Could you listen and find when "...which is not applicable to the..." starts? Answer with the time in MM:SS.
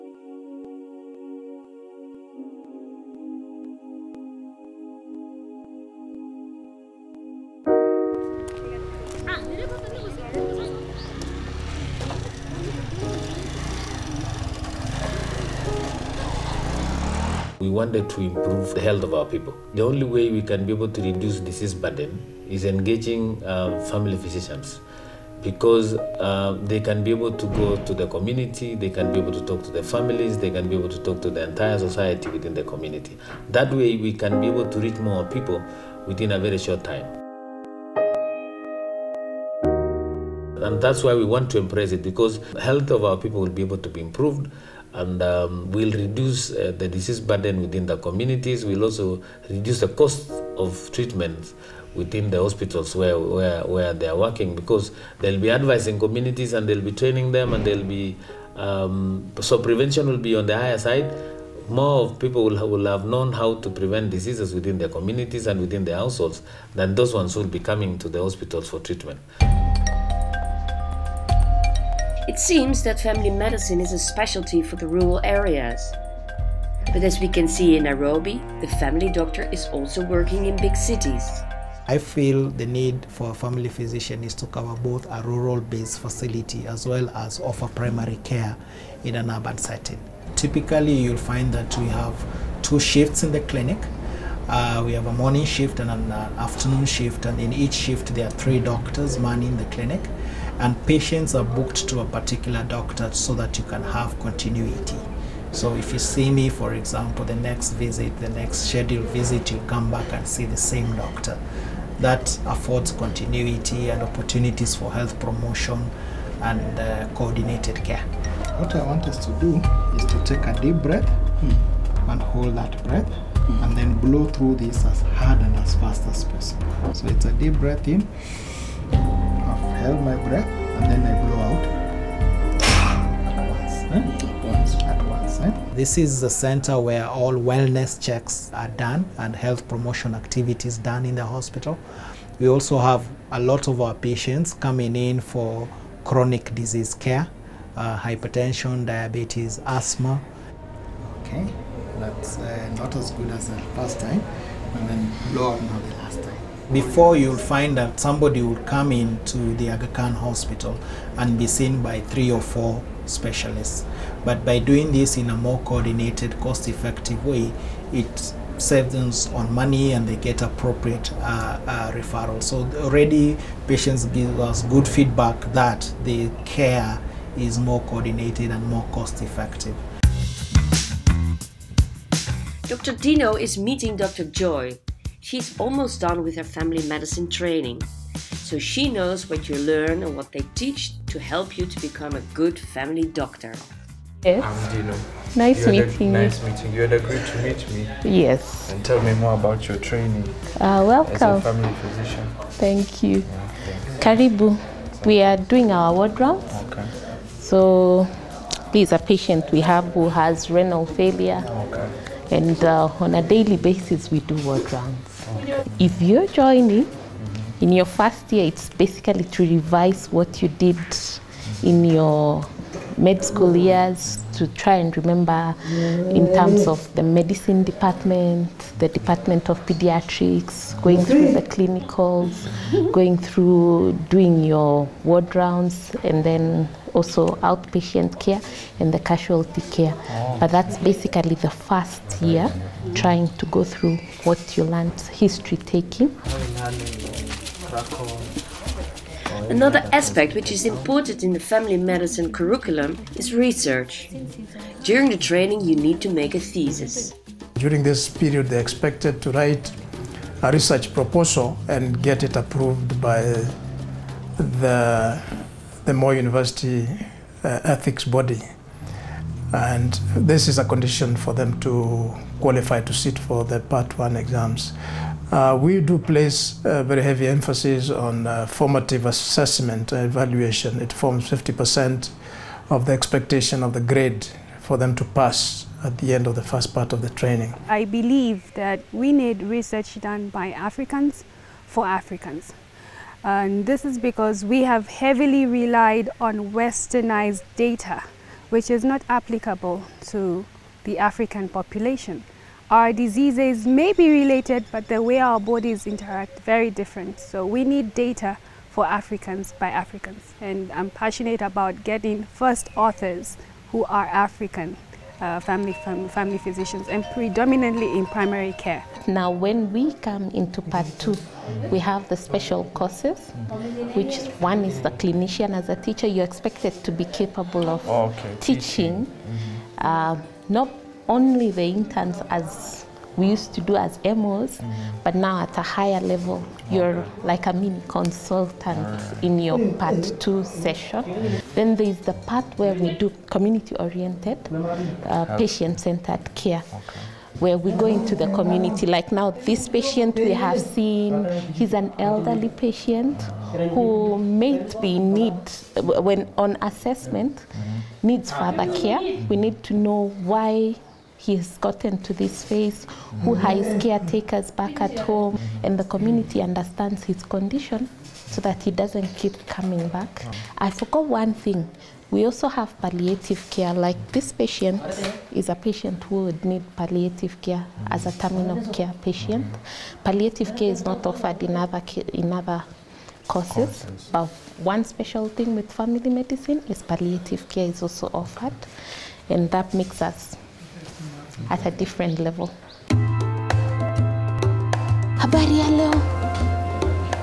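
04:58.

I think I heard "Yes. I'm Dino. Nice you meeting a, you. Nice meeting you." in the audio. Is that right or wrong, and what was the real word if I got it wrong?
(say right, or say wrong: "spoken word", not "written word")
right.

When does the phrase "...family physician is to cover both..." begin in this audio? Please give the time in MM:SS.
01:23.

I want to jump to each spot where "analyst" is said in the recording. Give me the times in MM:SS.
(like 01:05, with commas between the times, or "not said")
not said.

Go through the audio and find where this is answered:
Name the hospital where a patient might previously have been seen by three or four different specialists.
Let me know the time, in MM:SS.
02:39.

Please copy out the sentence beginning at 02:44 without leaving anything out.
But by doing this in a more coordinated, cost-effective way, it saves on money and they get appropriate uh, uh, referral.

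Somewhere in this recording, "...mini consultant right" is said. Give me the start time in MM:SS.
05:37.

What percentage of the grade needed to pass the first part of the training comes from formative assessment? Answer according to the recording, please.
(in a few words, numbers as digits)
50%.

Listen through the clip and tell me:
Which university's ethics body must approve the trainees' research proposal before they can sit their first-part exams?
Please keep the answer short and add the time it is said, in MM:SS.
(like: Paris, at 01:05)
Moi University, at 04:25.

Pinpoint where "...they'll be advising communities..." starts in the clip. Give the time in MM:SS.
00:55.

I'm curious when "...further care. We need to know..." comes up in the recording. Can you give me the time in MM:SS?
05:58.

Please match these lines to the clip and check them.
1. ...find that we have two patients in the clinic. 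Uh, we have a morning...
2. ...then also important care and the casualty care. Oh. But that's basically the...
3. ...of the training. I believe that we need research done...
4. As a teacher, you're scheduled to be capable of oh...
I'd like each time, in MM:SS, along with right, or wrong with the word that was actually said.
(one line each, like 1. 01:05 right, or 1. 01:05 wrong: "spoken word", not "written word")
1. 01:31 wrong: "shifts", not "patients"
2. 03:56 wrong: "outpatient", not "important"
3. 04:46 right
4. 05:25 wrong: "expected", not "scheduled".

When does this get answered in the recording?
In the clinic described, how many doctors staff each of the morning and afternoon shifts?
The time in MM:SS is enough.
01:38.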